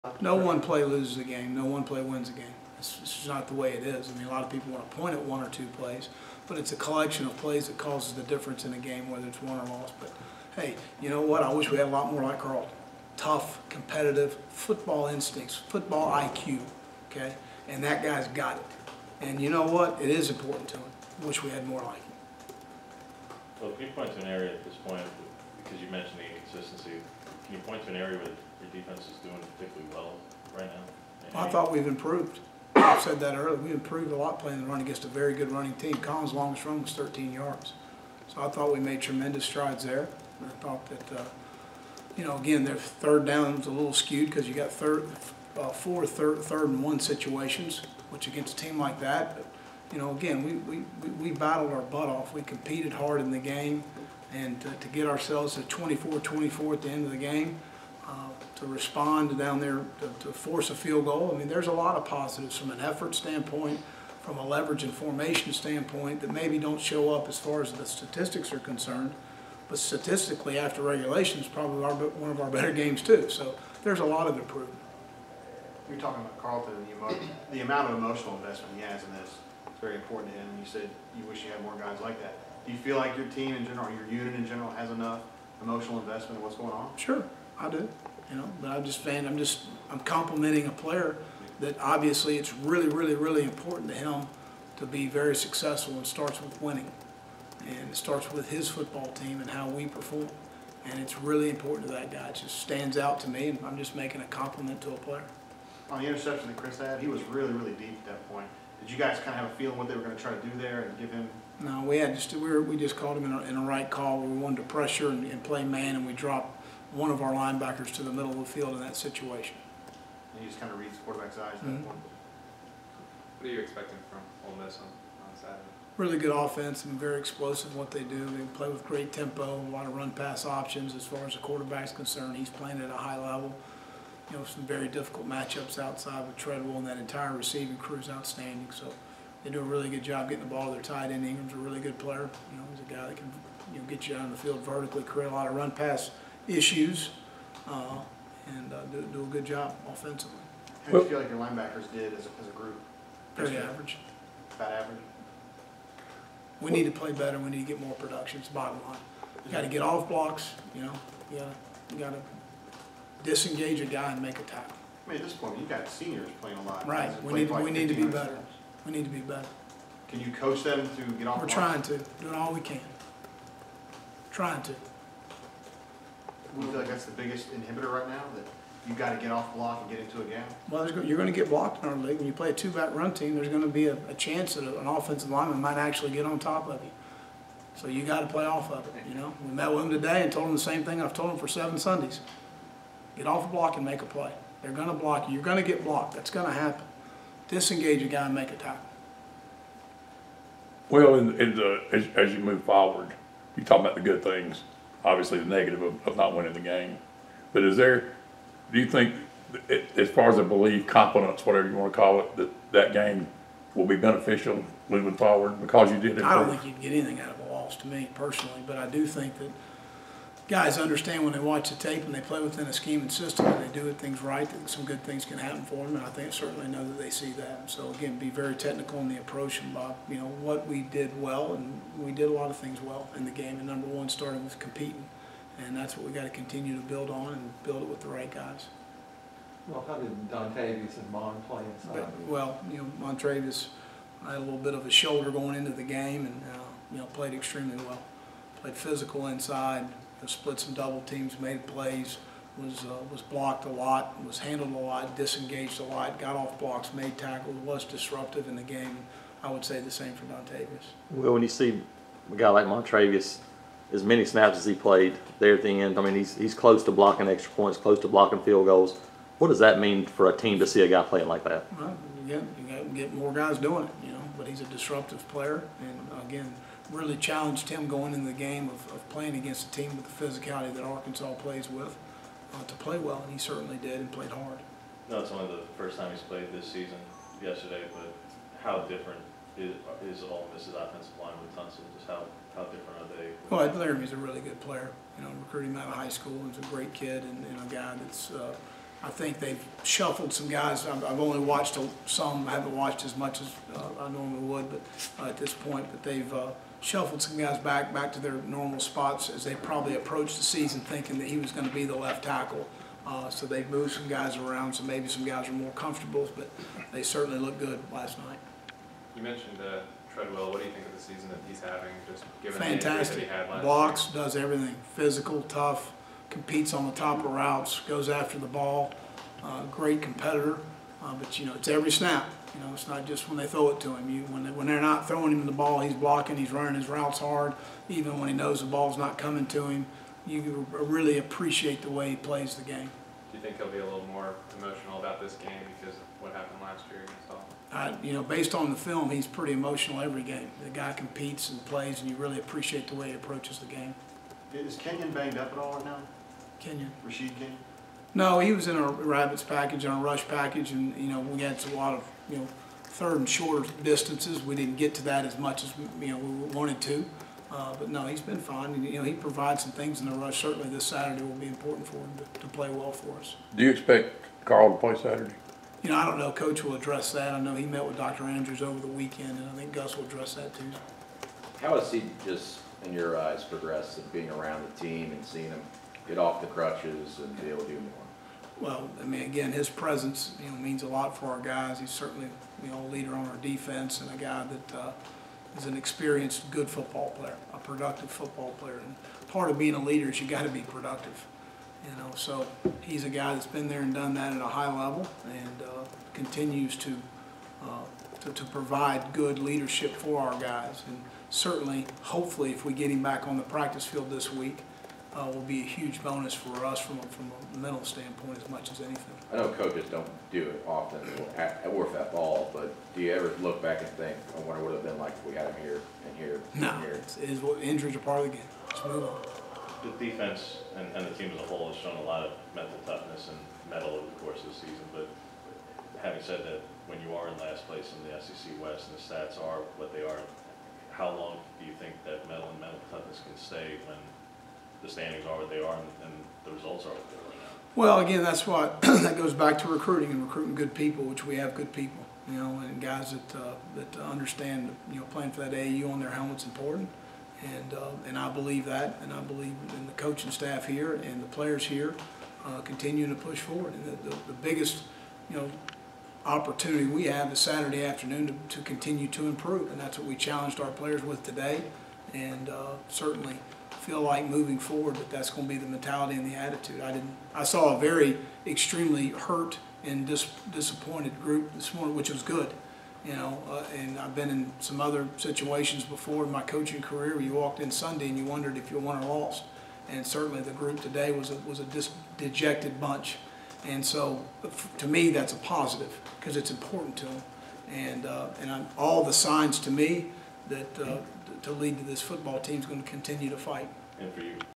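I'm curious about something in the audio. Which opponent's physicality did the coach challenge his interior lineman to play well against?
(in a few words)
Arkansas.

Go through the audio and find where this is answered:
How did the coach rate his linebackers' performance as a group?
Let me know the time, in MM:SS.
02:33.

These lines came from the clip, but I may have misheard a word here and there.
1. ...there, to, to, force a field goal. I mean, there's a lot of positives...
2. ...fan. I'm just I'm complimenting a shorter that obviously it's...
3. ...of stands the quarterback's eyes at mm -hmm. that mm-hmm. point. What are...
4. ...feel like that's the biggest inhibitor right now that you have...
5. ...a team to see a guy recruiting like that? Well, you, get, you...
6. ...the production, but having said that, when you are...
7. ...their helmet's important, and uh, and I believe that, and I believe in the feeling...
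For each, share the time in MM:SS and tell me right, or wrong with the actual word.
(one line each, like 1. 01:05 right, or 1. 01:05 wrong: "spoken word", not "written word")
1. 00:59 right
2. 01:28 wrong: "player", not "shorter"
3. 02:00 wrong: "reads", not "stands"
4. 02:56 right
5. 04:30 wrong: "playing", not "recruiting"
6. 07:14 wrong: "season", not "production"
7. 07:35 wrong: "coaching", not "feeling".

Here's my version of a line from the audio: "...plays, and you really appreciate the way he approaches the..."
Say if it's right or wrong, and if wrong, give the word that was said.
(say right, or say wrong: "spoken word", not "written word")
right.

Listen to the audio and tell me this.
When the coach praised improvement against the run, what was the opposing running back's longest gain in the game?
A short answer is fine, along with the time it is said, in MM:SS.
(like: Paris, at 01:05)
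13 yards, at 00:36.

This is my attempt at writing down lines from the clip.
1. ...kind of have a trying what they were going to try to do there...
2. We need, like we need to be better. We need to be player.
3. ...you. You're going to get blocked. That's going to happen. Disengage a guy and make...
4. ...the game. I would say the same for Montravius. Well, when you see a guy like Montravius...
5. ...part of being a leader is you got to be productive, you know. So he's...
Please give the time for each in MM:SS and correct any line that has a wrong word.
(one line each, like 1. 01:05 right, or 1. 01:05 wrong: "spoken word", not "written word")
1. 01:49 wrong: "feeling", not "trying"
2. 02:47 wrong: "better", not "player"
3. 03:15 right
4. 04:18 wrong: "Dontavius", not "Montravius"
5. 06:39 right.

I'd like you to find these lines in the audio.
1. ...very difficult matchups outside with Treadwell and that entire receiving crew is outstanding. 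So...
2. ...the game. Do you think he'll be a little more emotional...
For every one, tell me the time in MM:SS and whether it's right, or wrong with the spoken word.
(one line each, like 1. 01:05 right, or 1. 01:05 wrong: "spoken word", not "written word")
1. 02:14 right
2. 05:42 right.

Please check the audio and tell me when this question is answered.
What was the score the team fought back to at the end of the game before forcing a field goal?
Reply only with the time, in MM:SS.
00:55.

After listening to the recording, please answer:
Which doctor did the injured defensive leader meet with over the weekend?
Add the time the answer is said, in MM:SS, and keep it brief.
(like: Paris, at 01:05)
Dr. Andrews, at 06:17.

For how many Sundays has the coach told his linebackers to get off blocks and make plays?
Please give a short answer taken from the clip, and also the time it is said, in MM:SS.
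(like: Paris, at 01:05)
7, at 03:11.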